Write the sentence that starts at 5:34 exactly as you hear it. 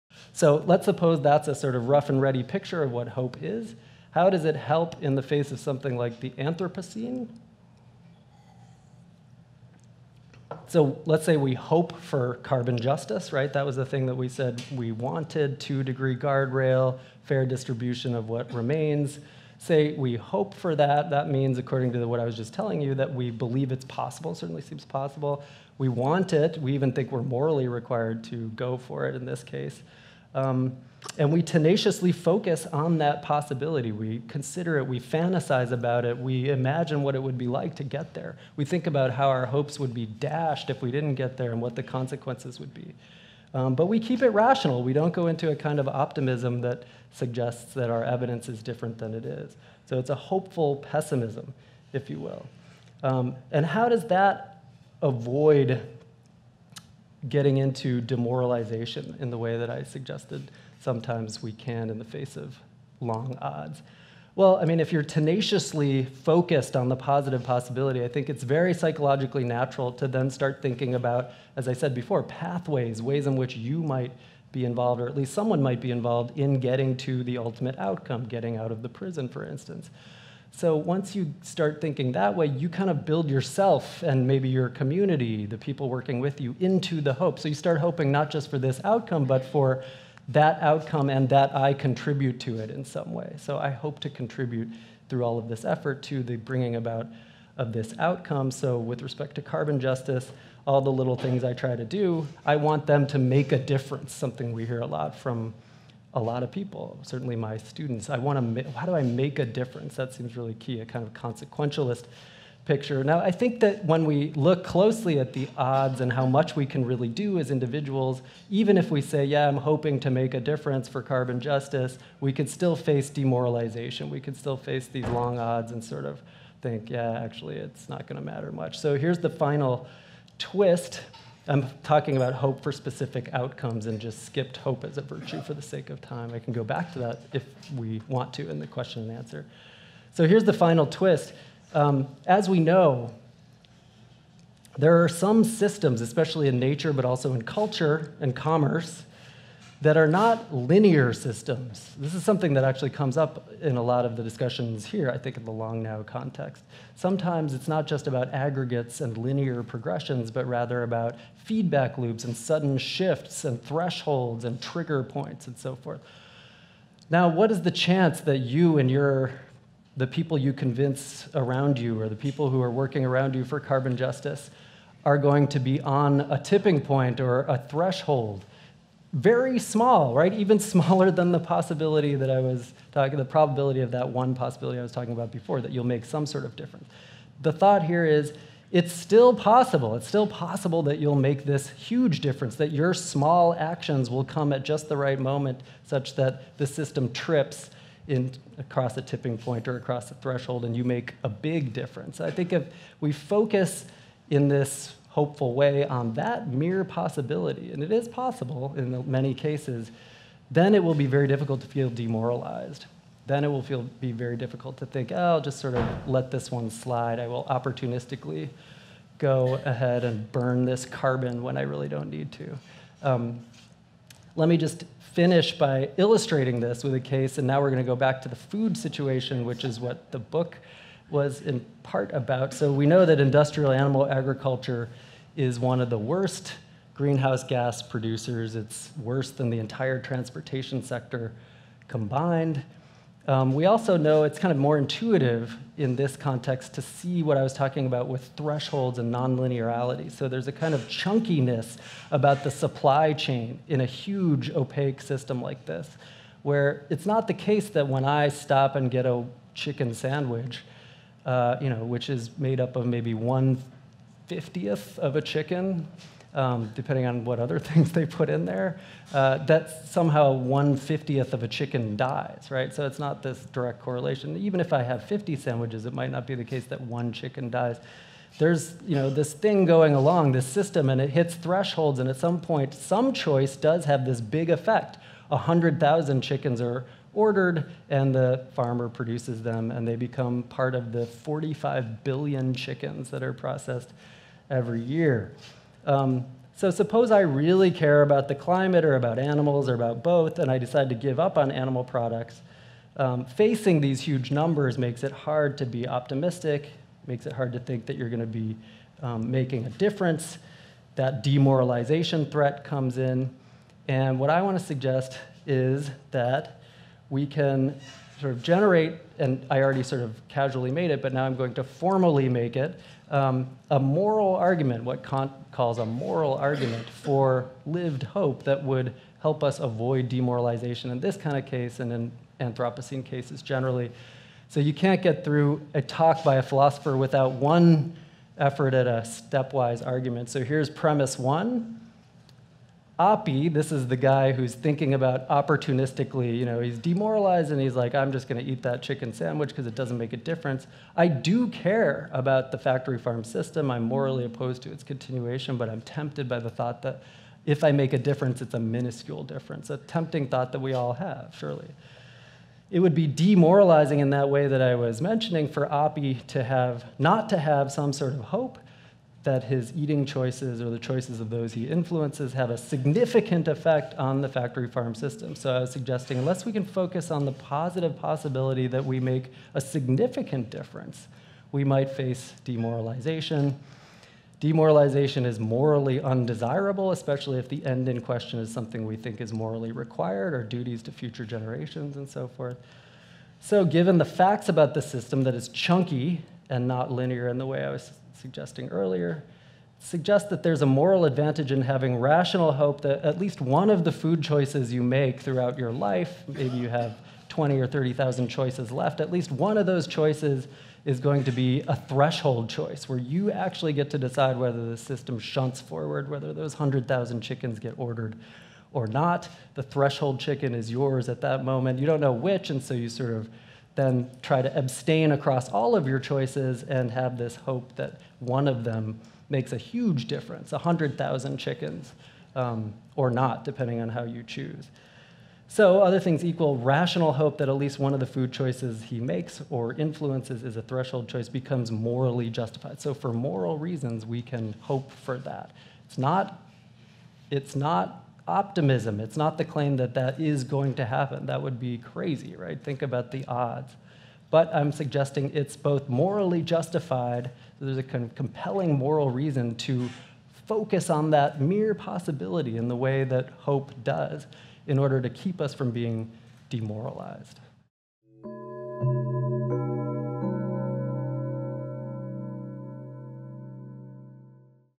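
So you can't get through a talk by a philosopher without one effort at a stepwise argument.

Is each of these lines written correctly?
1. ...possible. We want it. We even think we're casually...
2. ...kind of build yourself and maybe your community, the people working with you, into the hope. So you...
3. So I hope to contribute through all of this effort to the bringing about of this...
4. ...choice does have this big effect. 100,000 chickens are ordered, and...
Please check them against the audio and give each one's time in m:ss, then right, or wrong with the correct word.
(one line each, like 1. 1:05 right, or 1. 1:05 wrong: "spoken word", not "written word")
1. 0:24 wrong: "morally", not "casually"
2. 1:22 right
3. 1:33 right
4. 4:43 right.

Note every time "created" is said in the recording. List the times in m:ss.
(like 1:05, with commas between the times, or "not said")
not said.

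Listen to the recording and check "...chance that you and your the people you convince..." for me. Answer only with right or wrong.
right.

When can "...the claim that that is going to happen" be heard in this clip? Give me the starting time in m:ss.
7:29.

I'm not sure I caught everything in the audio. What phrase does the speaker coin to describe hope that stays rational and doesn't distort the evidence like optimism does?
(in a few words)
hopeful pessimism.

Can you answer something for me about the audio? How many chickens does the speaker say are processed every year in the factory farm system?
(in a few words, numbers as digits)
45 billion.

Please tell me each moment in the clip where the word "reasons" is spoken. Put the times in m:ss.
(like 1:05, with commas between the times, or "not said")
7:23, 7:39.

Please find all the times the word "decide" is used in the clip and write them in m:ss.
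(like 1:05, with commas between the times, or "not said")
5:00, 6:53.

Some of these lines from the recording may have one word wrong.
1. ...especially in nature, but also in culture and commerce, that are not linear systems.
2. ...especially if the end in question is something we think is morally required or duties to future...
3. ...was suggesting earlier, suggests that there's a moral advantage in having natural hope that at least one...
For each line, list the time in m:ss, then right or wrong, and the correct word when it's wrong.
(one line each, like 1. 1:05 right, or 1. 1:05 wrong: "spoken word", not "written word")
1. 2:25 right
2. 6:26 right
3. 6:37 wrong: "rational", not "natural".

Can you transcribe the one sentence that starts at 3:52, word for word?
So we know that industrial animal agriculture is one of the worst greenhouse gas producers.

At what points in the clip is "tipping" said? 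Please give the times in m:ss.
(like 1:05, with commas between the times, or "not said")
2:56, 3:19.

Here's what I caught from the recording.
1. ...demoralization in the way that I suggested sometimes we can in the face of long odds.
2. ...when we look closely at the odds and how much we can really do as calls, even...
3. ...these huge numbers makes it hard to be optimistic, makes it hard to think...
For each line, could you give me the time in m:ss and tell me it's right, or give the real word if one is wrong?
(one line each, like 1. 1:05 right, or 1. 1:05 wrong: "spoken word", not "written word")
1. 0:58 right
2. 1:53 wrong: "individuals", not "calls"
3. 5:03 right.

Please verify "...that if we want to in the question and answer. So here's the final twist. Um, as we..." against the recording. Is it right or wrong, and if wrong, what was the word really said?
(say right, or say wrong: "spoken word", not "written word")
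right.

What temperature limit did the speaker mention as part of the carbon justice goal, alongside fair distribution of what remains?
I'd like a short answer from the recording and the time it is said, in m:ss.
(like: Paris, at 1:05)
2 degree guardrail, at 0:15.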